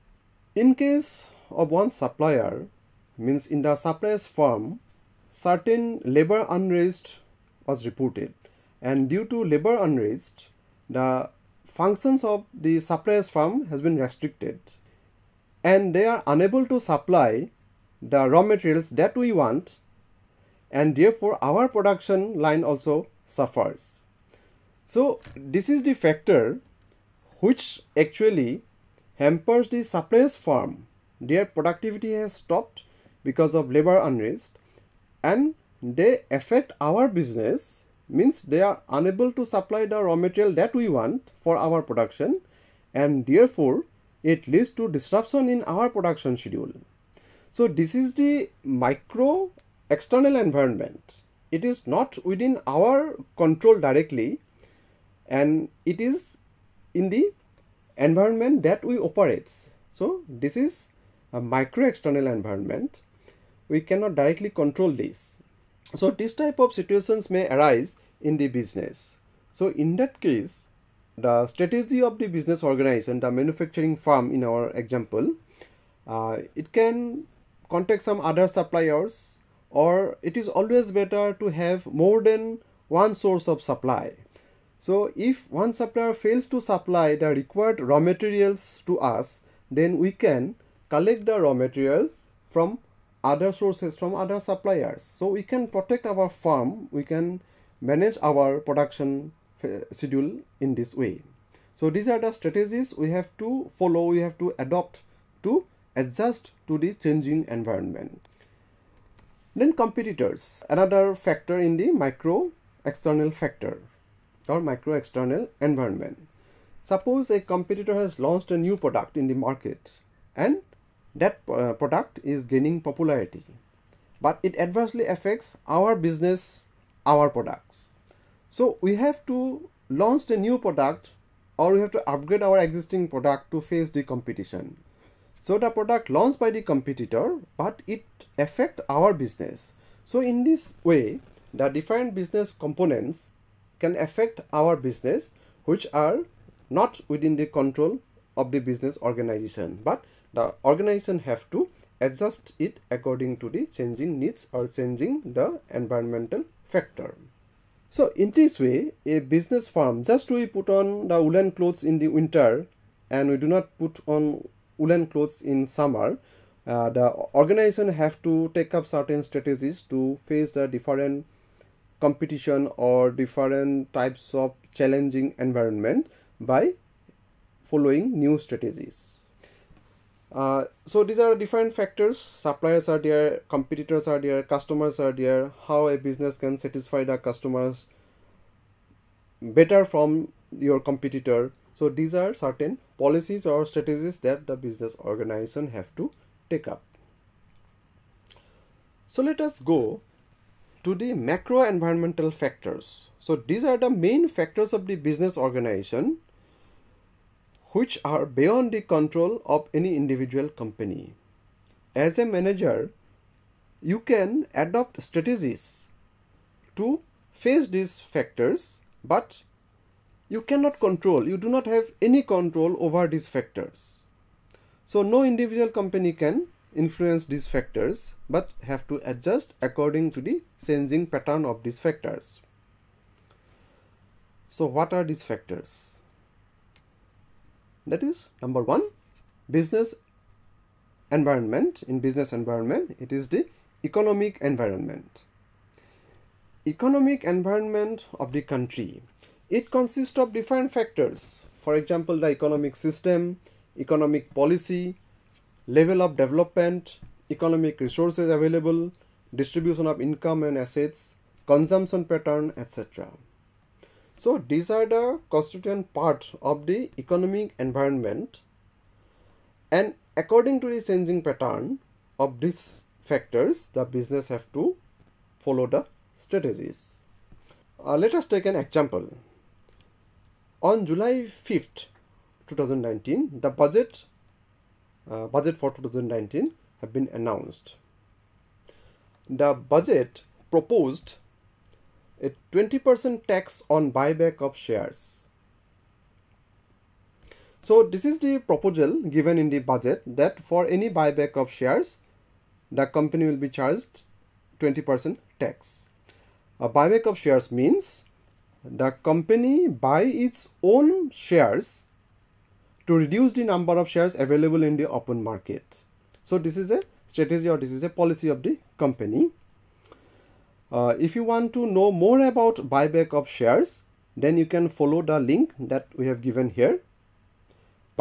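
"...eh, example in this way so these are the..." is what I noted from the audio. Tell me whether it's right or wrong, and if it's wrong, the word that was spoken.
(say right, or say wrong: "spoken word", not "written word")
wrong: "schedule", not "example".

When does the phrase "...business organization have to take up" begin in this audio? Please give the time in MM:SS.
03:14.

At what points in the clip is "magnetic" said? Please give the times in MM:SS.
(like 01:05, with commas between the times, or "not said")
not said.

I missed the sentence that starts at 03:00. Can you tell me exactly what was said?
Uh, so these are different factors.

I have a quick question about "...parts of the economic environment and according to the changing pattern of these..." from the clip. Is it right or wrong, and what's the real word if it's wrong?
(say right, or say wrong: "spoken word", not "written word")
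right.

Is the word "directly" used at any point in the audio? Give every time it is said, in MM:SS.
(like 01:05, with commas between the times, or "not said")
00:53, 01:04.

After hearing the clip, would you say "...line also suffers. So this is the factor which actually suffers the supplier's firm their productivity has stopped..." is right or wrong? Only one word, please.
wrong.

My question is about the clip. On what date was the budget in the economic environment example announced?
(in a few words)
July 5th 2019.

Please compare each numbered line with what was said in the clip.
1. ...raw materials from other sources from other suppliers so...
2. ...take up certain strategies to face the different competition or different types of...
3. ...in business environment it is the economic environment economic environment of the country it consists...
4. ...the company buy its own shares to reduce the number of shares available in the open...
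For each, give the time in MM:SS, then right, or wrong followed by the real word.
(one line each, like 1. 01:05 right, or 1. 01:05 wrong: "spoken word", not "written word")
1. 01:31 right
2. 02:48 right
3. 04:01 right
4. 05:08 right.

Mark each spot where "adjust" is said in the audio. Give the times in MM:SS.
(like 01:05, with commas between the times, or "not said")
01:46, 02:31, 03:49.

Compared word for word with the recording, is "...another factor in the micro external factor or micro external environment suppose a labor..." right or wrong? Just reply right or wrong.
wrong.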